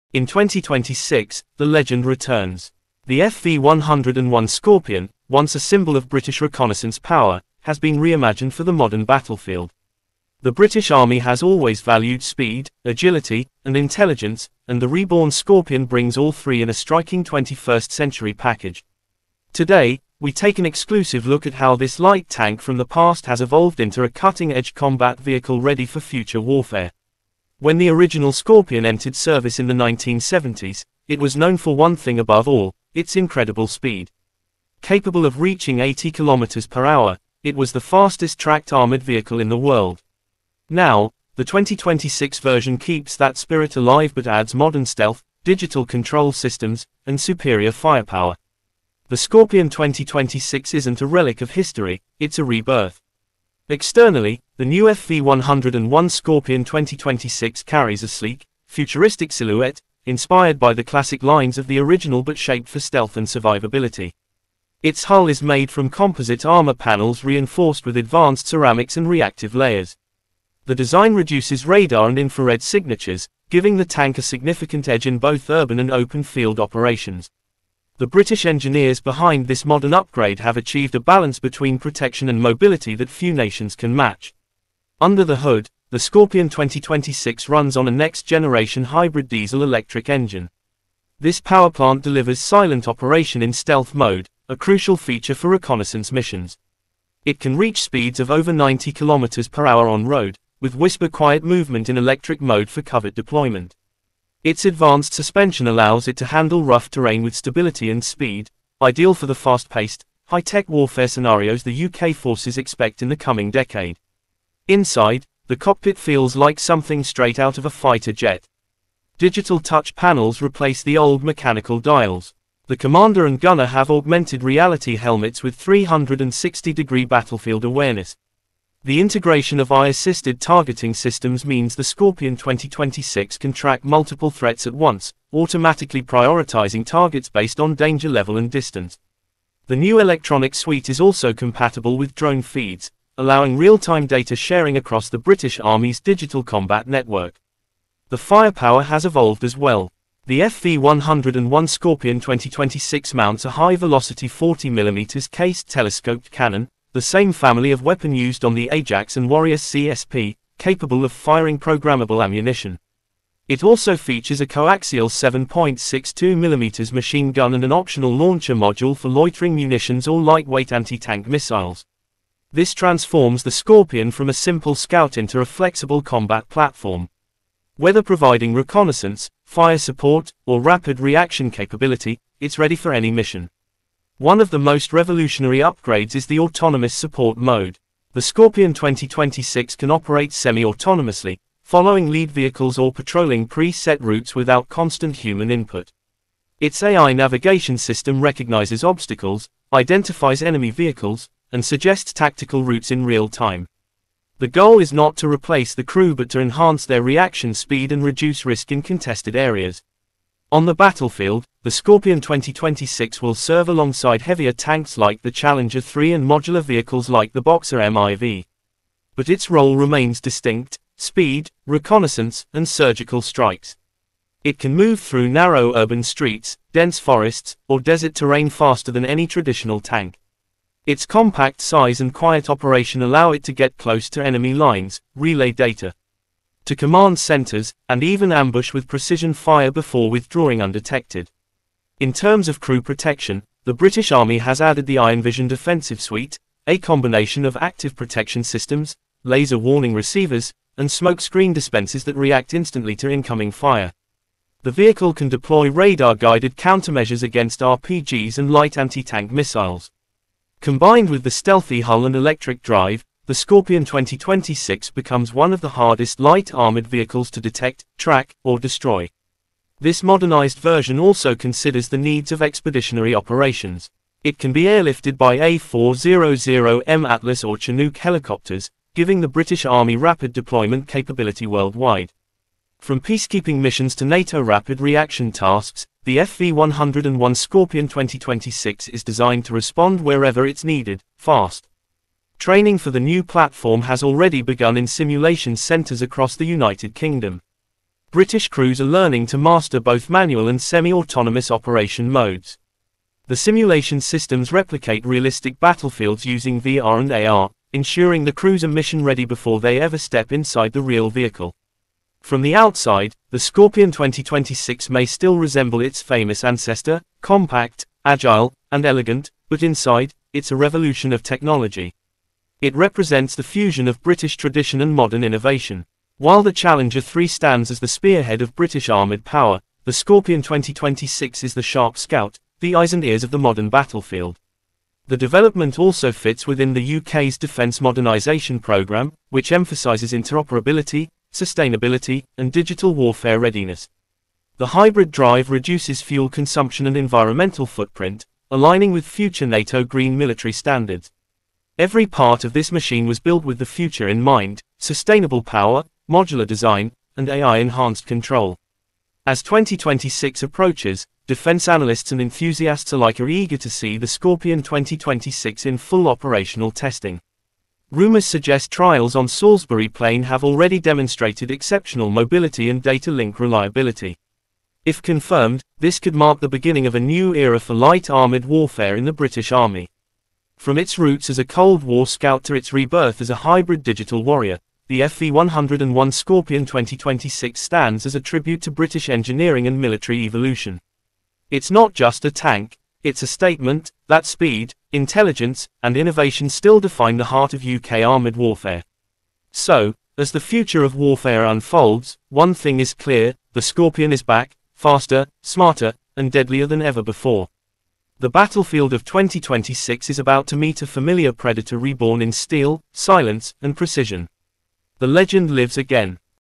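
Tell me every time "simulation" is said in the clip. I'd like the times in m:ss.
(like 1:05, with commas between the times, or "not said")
4:54, 5:03.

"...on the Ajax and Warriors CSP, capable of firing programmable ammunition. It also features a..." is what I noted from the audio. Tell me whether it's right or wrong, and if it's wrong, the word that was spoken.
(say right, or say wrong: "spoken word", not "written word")
right.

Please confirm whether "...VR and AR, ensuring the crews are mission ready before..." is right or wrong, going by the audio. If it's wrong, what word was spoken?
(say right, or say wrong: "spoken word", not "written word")
right.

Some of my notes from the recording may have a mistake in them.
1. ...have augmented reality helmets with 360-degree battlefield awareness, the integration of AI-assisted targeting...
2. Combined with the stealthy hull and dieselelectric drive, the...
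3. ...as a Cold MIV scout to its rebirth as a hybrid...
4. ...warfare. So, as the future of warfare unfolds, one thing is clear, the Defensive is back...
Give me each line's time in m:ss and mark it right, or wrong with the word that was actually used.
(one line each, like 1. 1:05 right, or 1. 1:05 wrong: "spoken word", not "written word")
1. 2:03 right
2. 4:20 wrong: "electric", not "dieselelectric"
3. 6:21 wrong: "War", not "MIV"
4. 6:38 wrong: "Scorpion", not "Defensive".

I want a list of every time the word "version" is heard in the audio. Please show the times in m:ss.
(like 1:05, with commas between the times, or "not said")
0:42, 4:30.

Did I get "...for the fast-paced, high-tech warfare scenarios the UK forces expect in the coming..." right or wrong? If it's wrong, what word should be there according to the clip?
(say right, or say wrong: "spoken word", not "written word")
right.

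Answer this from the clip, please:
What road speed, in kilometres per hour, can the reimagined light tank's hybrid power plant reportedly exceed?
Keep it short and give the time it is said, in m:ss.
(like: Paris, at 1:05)
90 km/h, at 1:38.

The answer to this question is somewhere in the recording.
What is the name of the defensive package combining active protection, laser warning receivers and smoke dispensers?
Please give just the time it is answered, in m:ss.
4:04.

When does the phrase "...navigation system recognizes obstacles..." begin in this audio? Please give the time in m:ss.
3:17.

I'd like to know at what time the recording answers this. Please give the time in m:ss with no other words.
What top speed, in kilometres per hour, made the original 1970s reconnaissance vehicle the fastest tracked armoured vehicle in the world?
0:35.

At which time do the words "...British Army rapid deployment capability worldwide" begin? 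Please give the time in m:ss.
4:39.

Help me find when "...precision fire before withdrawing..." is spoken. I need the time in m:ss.
3:58.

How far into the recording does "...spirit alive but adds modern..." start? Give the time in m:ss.
0:43.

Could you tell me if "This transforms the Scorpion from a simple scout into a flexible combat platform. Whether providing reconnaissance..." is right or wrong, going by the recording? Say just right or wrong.
right.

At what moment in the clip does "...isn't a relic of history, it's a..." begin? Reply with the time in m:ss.
0:50.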